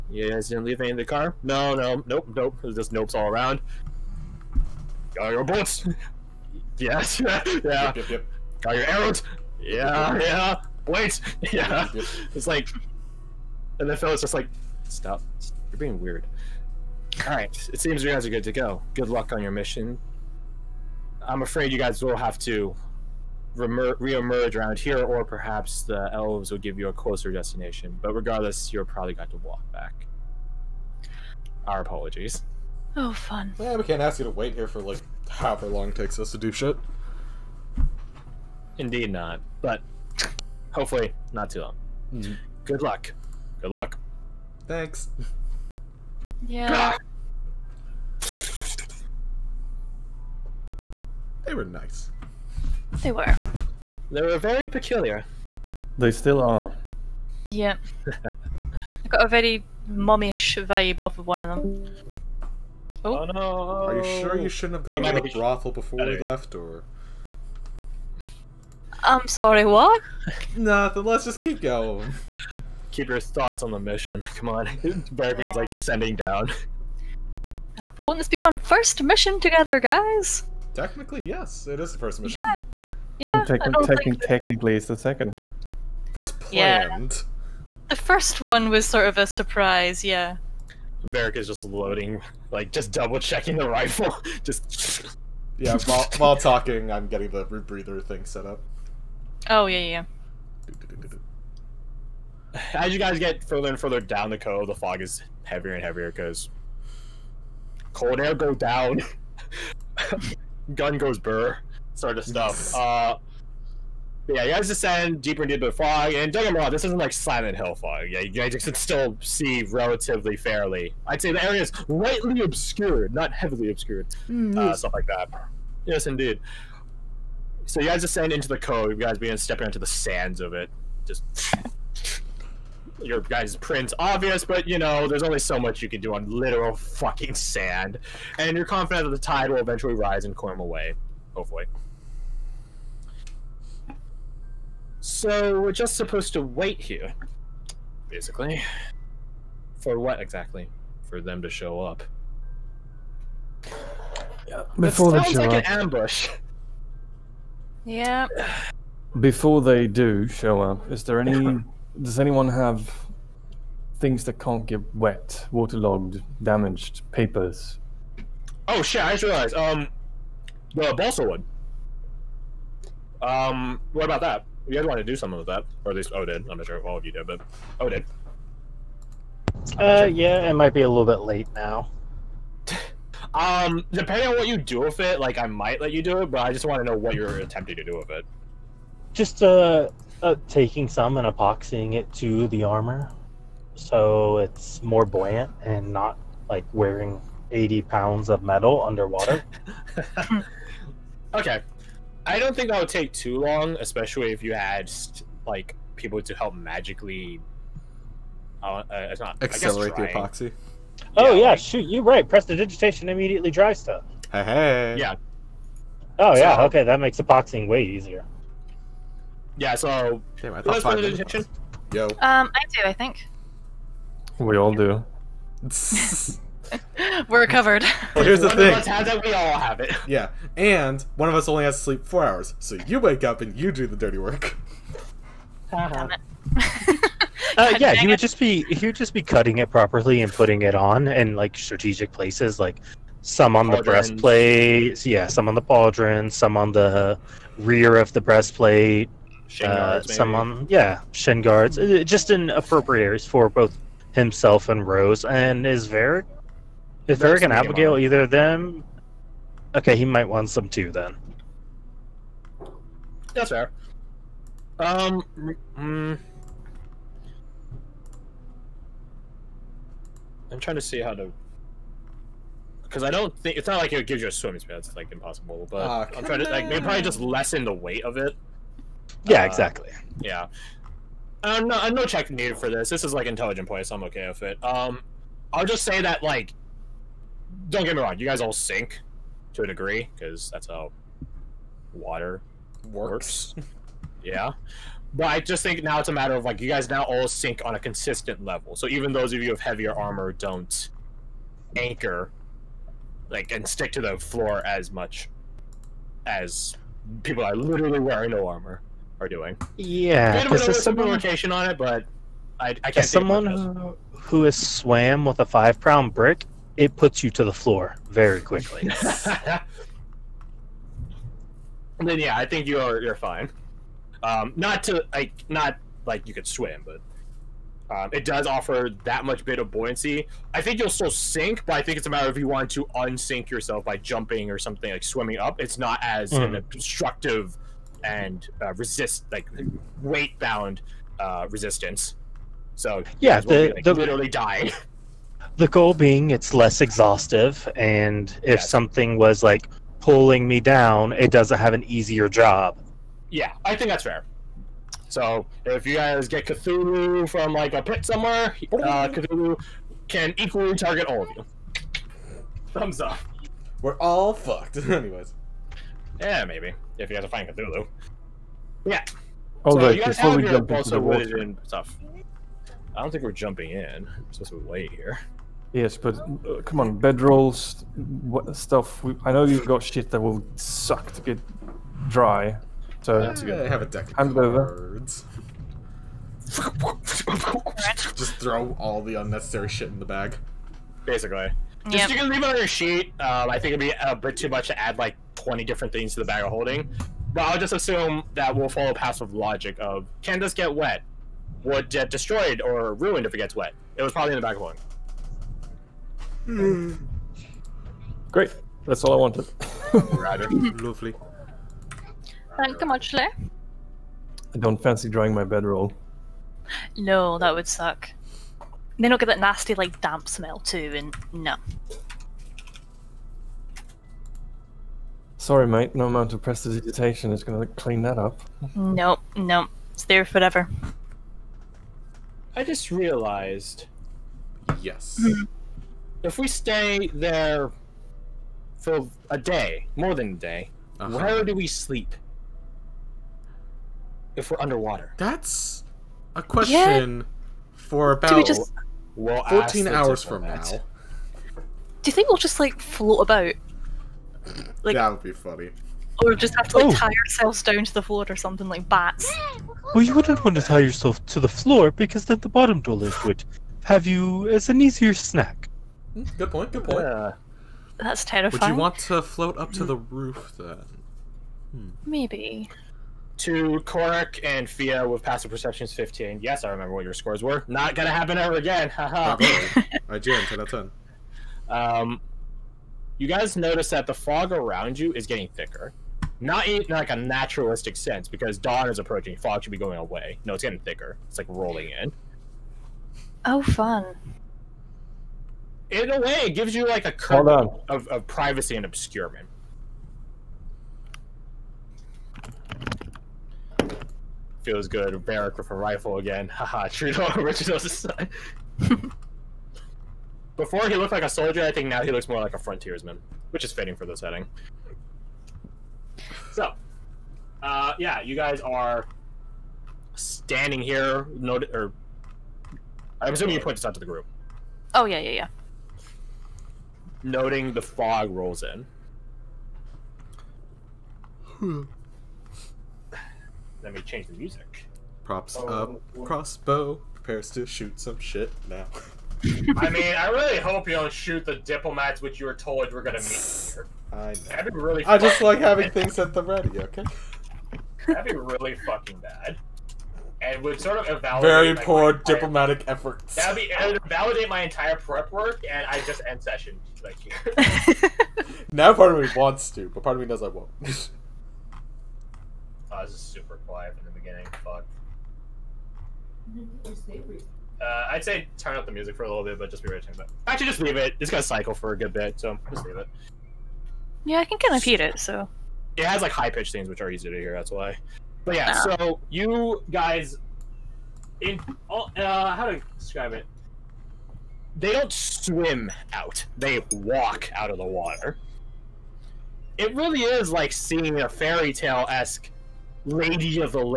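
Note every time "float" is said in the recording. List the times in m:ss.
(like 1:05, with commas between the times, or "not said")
7:32, 7:49.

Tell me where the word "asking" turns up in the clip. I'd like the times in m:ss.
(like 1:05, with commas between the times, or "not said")
not said.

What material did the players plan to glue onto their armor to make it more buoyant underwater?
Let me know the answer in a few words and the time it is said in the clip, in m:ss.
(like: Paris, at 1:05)
balsa wood, at 2:50.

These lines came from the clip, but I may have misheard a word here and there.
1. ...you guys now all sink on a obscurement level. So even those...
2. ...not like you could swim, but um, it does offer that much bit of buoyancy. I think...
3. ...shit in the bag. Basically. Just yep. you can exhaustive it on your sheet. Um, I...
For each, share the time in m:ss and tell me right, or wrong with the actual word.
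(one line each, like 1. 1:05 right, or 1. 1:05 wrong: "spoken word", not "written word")
1. 4:56 wrong: "consistent", not "obscurement"
2. 5:25 right
3. 6:29 wrong: "leave", not "exhaustive".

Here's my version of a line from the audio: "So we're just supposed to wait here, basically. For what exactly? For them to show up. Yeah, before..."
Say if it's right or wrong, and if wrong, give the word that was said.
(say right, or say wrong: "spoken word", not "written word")
right.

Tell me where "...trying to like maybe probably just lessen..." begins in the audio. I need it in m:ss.
4:36.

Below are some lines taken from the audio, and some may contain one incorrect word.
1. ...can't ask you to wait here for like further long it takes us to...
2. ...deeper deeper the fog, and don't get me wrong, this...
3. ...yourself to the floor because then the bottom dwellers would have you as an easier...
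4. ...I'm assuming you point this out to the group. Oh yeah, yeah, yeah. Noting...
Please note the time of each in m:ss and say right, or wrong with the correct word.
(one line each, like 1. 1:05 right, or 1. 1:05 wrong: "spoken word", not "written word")
1. 0:33 wrong: "however", not "further"
2. 1:55 right
3. 7:40 right
4. 8:43 right.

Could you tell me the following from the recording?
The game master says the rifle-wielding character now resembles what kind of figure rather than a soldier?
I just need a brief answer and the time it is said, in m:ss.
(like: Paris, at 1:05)
a frontiersman, at 8:32.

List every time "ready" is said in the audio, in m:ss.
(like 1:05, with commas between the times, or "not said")
9:06, 9:29.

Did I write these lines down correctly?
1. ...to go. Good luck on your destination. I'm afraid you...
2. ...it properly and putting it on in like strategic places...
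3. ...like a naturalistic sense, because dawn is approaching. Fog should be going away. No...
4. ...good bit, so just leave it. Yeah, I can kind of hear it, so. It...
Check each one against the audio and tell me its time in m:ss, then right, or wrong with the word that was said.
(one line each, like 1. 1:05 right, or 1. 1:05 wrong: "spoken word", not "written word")
1. 0:18 wrong: "mission", not "destination"
2. 3:59 right
3. 8:06 right
4. 9:31 right.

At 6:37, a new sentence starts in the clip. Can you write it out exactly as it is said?
But I'll just assume that we'll follow passive logic of can this get wet?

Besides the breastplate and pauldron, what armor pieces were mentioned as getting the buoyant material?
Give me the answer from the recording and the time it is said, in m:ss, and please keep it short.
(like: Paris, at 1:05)
shin guards, at 4:11.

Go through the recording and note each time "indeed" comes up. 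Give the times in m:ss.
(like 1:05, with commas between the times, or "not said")
0:38, 2:06.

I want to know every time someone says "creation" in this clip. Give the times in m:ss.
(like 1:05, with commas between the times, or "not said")
not said.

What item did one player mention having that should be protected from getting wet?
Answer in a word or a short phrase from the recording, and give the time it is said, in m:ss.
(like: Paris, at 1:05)
a deck of cards, at 6:23.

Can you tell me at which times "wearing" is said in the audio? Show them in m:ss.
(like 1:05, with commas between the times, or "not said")
3:16, 5:07.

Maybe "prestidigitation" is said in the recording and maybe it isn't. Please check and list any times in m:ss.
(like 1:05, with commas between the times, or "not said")
3:32, 7:06.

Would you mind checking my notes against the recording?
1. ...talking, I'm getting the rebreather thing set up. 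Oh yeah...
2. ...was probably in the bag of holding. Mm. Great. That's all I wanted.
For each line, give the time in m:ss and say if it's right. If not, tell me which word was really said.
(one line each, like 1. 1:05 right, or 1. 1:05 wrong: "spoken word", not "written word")
1. 1:36 right
2. 6:44 right.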